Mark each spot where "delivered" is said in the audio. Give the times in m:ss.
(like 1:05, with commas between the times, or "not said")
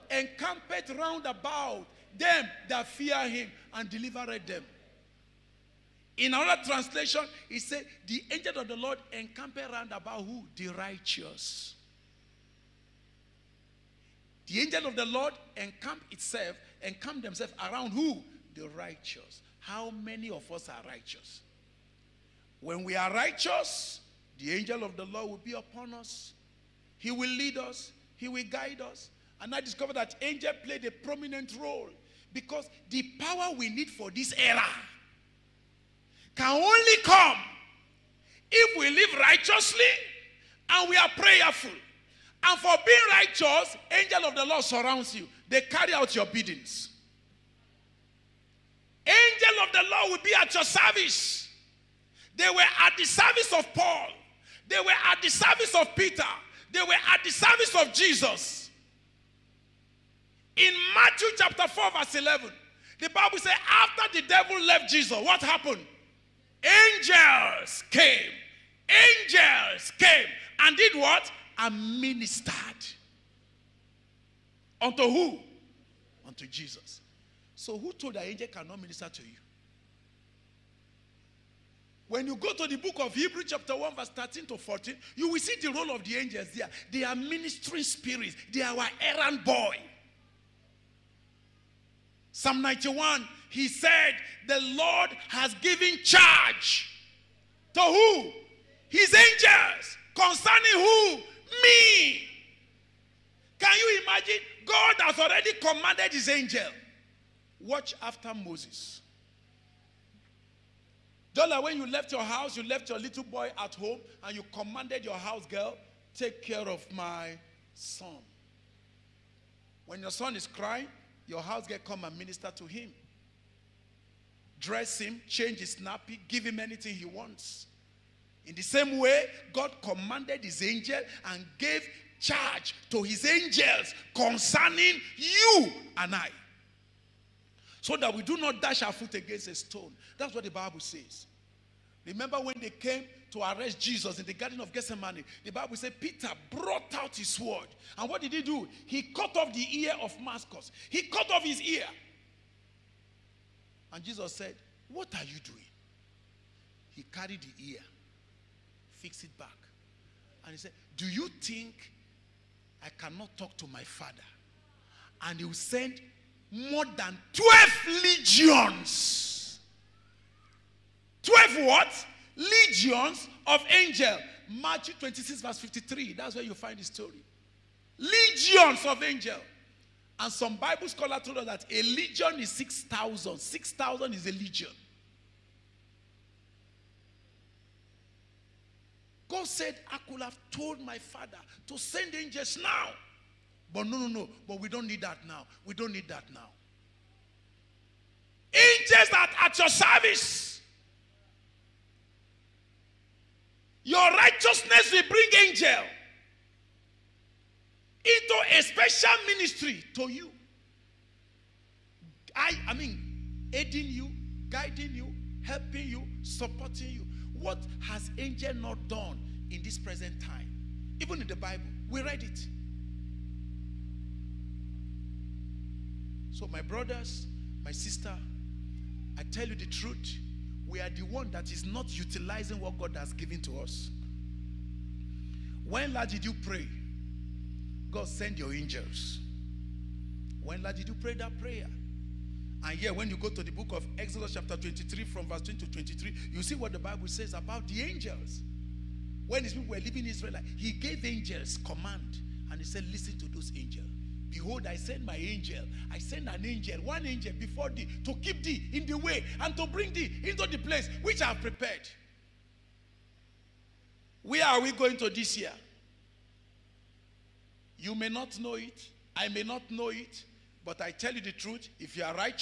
0:03.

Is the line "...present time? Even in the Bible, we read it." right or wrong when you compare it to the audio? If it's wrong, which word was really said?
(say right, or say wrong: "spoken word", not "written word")
right.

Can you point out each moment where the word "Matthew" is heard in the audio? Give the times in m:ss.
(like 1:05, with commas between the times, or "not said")
1:00, 2:54.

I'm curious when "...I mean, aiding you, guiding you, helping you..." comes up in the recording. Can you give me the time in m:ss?
3:32.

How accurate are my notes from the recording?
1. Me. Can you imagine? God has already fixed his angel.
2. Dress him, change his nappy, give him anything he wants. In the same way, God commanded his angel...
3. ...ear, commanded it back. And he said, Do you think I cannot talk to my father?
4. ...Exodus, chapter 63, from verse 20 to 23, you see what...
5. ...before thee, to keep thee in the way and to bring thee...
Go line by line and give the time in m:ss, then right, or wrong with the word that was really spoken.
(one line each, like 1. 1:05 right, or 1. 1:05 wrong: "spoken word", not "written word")
1. 1:41 wrong: "commanded", not "fixed"
2. 2:04 right
3. 2:37 wrong: "fixed", not "commanded"
4. 4:03 wrong: "23", not "63"
5. 4:17 right.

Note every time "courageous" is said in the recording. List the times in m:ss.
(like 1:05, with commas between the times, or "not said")
not said.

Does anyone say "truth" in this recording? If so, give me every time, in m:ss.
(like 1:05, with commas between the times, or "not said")
3:49, 4:31.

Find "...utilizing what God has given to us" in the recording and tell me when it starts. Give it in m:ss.
3:51.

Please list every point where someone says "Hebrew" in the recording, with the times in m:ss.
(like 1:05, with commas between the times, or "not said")
1:23.